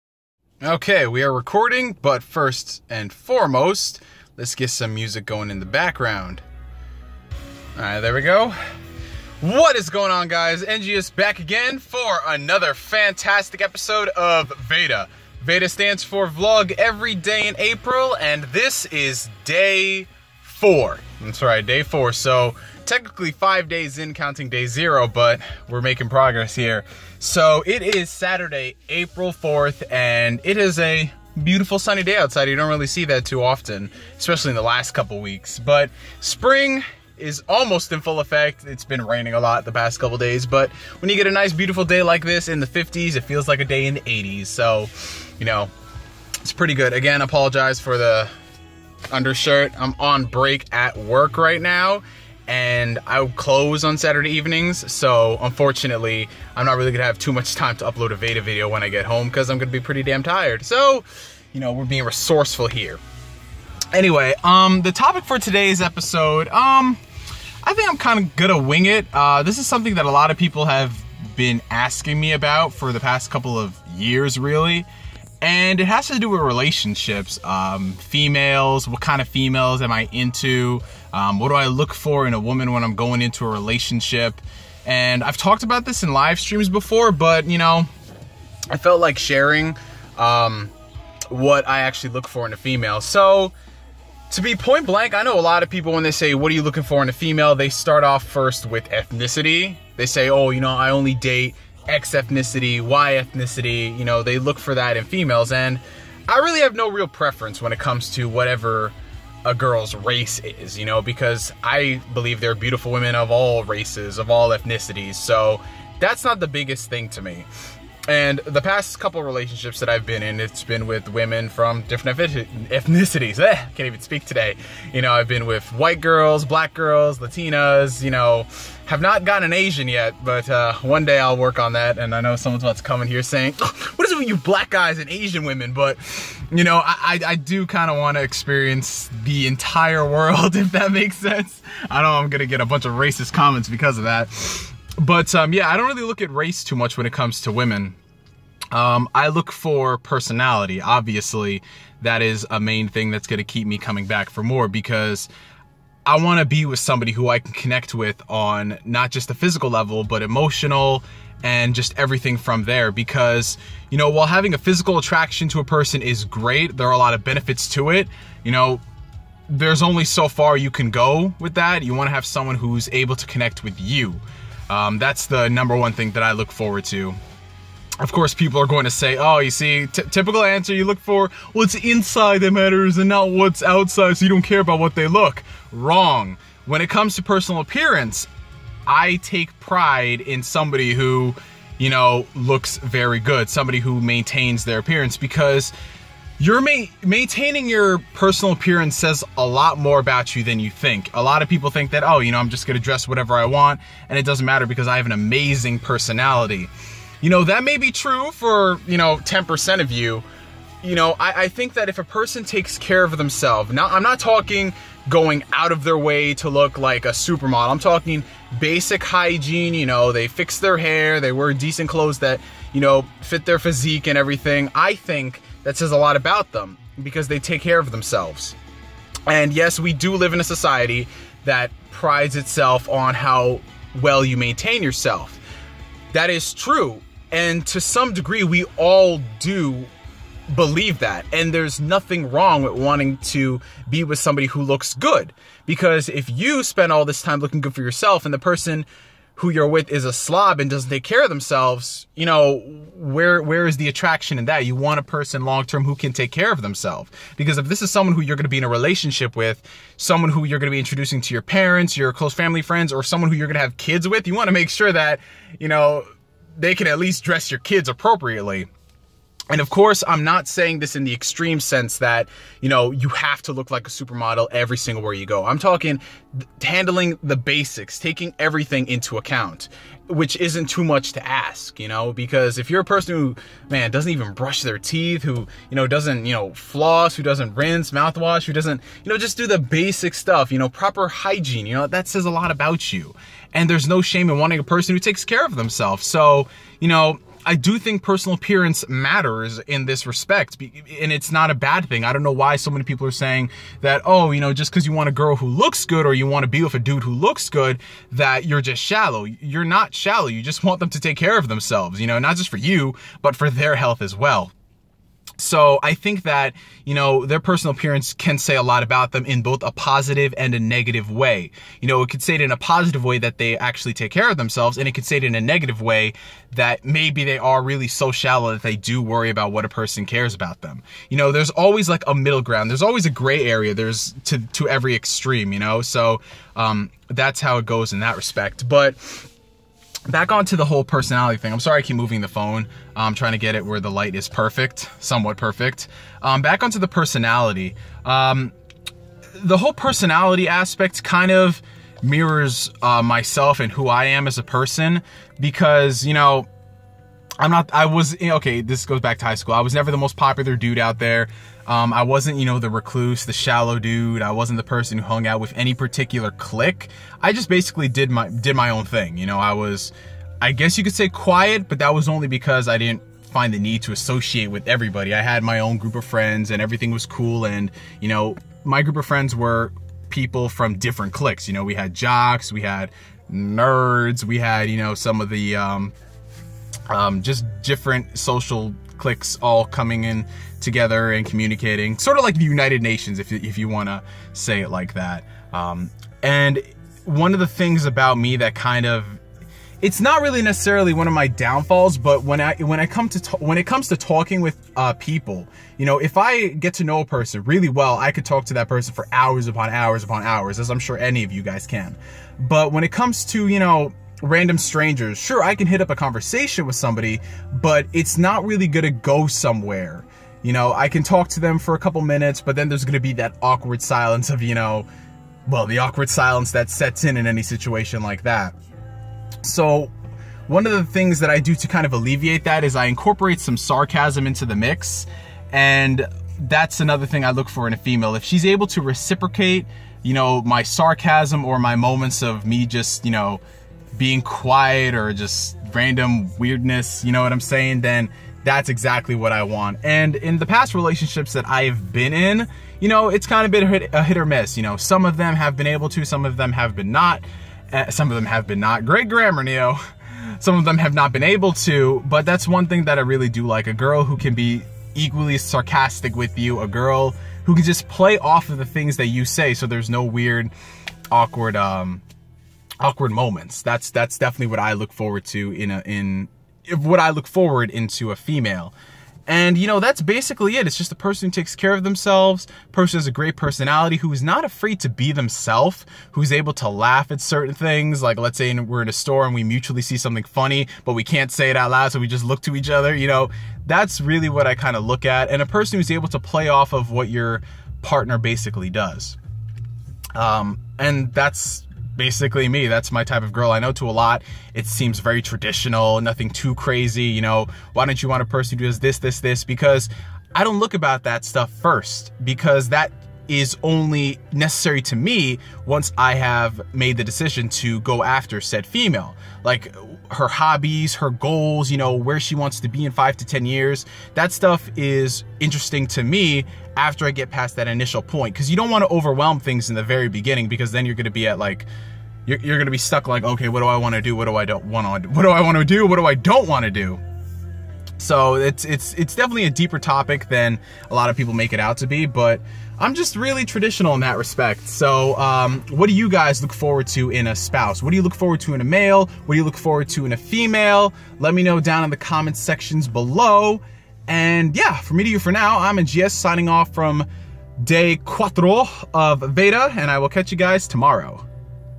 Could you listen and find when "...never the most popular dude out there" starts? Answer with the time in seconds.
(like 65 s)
359 s.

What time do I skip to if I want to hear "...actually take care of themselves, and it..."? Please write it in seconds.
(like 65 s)
323 s.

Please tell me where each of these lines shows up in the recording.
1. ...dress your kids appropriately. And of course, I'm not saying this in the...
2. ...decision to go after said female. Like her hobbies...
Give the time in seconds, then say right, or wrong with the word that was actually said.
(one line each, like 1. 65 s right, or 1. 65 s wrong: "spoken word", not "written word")
1. 267 s right
2. 517 s right.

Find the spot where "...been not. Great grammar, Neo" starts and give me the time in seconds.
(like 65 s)
458 s.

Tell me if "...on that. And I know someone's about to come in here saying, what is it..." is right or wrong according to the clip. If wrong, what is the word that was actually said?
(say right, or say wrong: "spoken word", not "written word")
right.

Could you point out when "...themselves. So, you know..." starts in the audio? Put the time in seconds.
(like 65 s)
295 s.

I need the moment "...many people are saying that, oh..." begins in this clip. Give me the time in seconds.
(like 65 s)
302 s.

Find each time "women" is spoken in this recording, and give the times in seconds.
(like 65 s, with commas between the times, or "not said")
112 s, 121 s, 135 s, 147 s.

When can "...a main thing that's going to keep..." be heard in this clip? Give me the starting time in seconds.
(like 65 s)
152 s.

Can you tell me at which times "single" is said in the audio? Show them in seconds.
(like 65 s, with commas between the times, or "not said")
274 s.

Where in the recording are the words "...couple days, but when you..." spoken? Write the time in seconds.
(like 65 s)
40 s.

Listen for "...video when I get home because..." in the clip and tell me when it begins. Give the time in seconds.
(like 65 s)
58 s.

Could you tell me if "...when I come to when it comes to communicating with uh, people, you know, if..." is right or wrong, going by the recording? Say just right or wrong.
wrong.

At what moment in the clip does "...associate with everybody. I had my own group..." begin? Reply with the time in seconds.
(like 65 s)
373 s.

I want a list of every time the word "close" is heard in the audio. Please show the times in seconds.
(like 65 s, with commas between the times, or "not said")
53 s, 262 s.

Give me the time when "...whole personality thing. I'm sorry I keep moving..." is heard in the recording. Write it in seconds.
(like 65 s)
340 s.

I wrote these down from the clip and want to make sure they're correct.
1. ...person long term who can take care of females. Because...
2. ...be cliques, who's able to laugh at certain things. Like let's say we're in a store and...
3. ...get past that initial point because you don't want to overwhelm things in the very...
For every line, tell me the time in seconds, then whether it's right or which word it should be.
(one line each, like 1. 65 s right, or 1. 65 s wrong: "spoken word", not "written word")
1. 255 s wrong: "themselves", not "females"
2. 484 s wrong: "themselves", not "cliques"
3. 527 s right.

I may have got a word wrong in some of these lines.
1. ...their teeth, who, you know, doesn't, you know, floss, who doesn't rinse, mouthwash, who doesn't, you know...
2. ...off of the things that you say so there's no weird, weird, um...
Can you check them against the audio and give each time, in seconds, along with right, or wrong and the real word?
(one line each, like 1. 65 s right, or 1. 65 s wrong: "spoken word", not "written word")
1. 284 s right
2. 468 s wrong: "awkward", not "weird".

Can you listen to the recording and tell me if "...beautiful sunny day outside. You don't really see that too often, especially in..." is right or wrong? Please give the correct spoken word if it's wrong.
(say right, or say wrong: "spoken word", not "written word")
right.